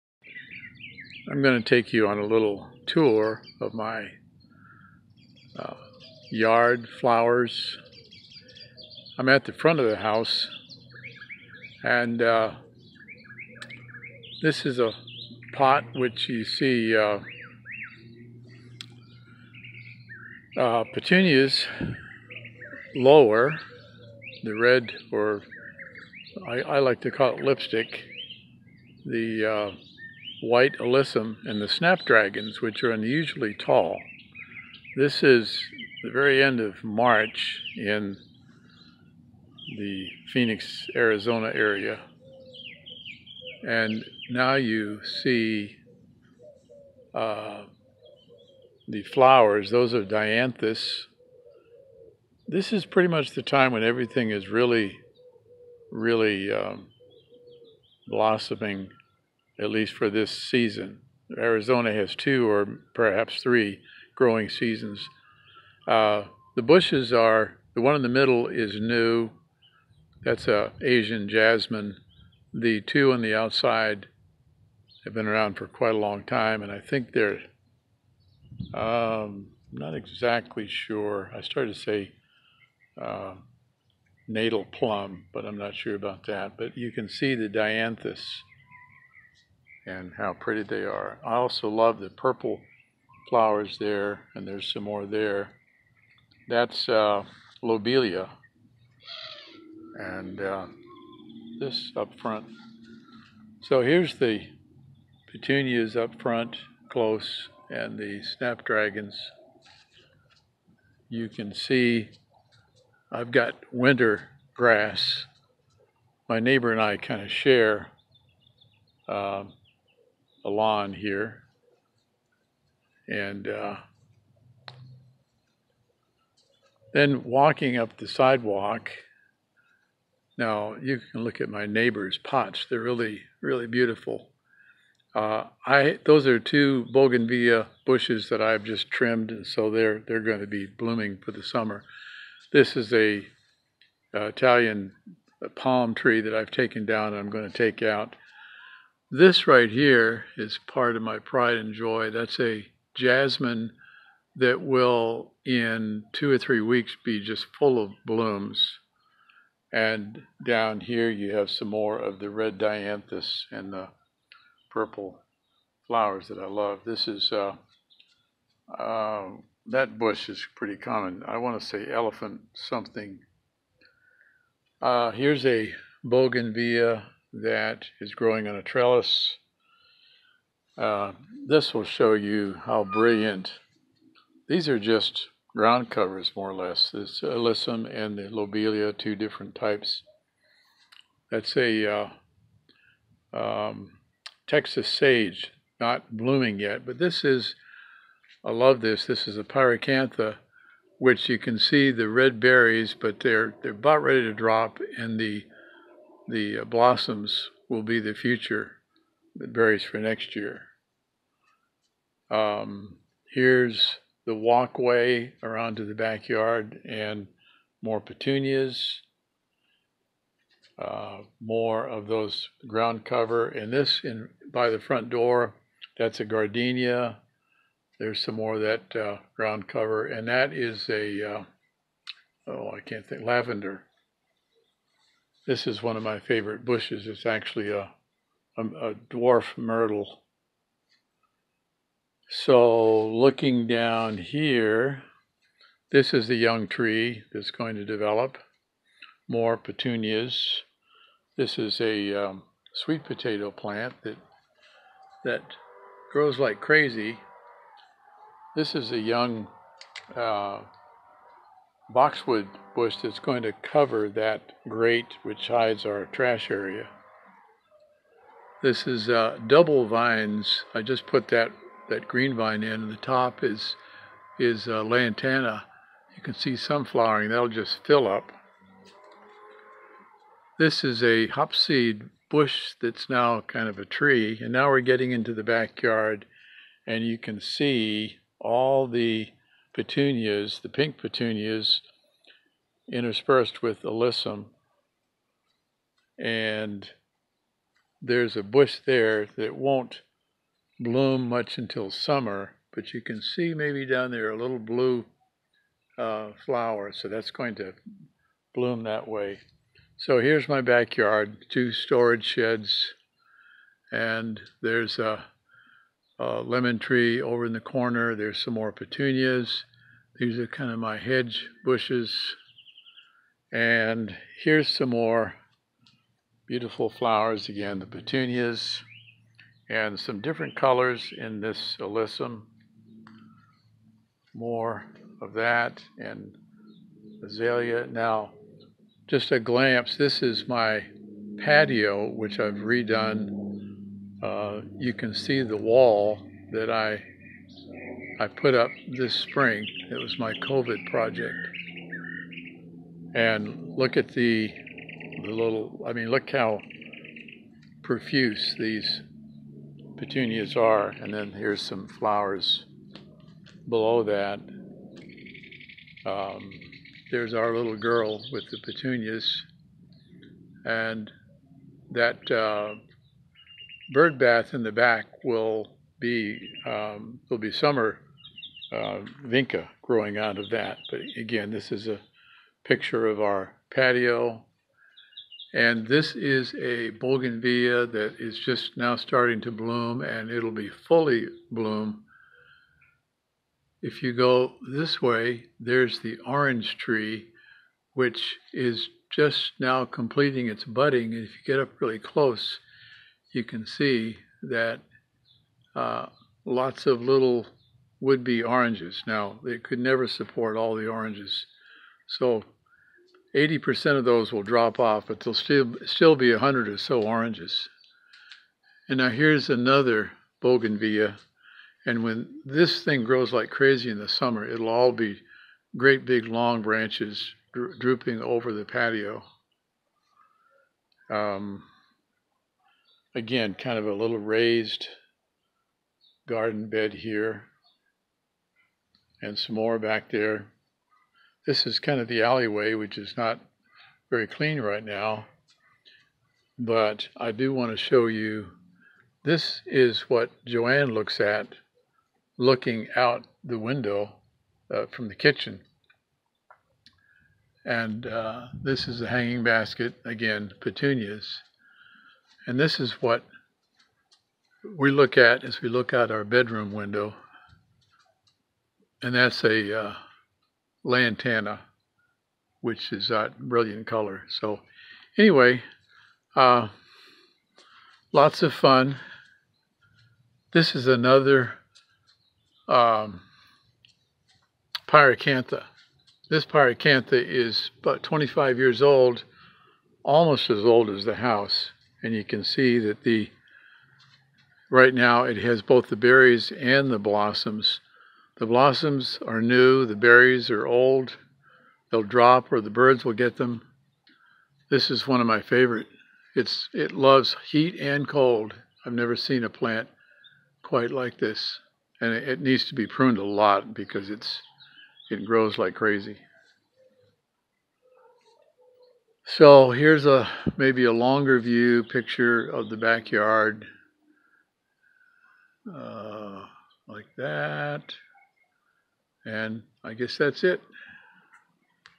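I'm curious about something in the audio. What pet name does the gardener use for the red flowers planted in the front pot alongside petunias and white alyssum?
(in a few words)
Lipstick.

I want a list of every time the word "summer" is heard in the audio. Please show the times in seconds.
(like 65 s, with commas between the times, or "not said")
141 s, 301 s, 377 s, 424 s.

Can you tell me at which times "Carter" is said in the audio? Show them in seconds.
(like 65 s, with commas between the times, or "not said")
not said.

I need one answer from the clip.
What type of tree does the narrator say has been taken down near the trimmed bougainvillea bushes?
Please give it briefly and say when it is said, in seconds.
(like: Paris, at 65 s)
Italian palm, at 144 s.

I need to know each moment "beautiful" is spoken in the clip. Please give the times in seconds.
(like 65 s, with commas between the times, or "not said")
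133 s, 326 s.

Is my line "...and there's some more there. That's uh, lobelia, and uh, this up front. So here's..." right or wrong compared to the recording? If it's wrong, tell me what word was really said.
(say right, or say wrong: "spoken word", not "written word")
right.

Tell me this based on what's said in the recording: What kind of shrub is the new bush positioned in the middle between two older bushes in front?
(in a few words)
Asian jasmine.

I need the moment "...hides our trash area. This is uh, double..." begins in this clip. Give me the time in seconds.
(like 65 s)
265 s.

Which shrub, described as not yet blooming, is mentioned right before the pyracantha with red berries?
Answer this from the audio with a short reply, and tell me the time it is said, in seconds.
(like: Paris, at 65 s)
Texas sage, at 194 s.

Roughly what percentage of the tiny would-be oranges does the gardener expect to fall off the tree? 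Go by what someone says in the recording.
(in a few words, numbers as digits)
80%.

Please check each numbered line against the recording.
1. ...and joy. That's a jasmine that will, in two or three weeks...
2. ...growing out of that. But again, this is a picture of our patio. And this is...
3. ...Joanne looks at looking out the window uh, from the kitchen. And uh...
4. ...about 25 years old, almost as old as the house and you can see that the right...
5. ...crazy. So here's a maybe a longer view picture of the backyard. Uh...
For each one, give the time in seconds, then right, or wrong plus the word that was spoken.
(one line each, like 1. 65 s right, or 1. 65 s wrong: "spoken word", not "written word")
1. 151 s right
2. 379 s right
3. 450 s right
4. 487 s right
5. 515 s right.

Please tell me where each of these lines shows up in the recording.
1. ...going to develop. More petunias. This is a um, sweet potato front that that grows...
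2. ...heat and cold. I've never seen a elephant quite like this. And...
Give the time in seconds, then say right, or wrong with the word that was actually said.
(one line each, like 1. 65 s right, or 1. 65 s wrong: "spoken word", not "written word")
1. 247 s wrong: "plant", not "front"
2. 507 s wrong: "plant", not "elephant".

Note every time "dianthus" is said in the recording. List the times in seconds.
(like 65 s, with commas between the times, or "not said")
50 s, 87 s, 162 s.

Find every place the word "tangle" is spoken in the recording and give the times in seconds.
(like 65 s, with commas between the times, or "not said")
not said.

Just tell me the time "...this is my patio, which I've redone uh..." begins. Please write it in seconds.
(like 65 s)
339 s.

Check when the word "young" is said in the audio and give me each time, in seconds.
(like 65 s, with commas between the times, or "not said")
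246 s, 258 s.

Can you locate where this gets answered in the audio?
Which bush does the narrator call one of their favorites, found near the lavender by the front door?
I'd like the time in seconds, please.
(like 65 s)
238 s.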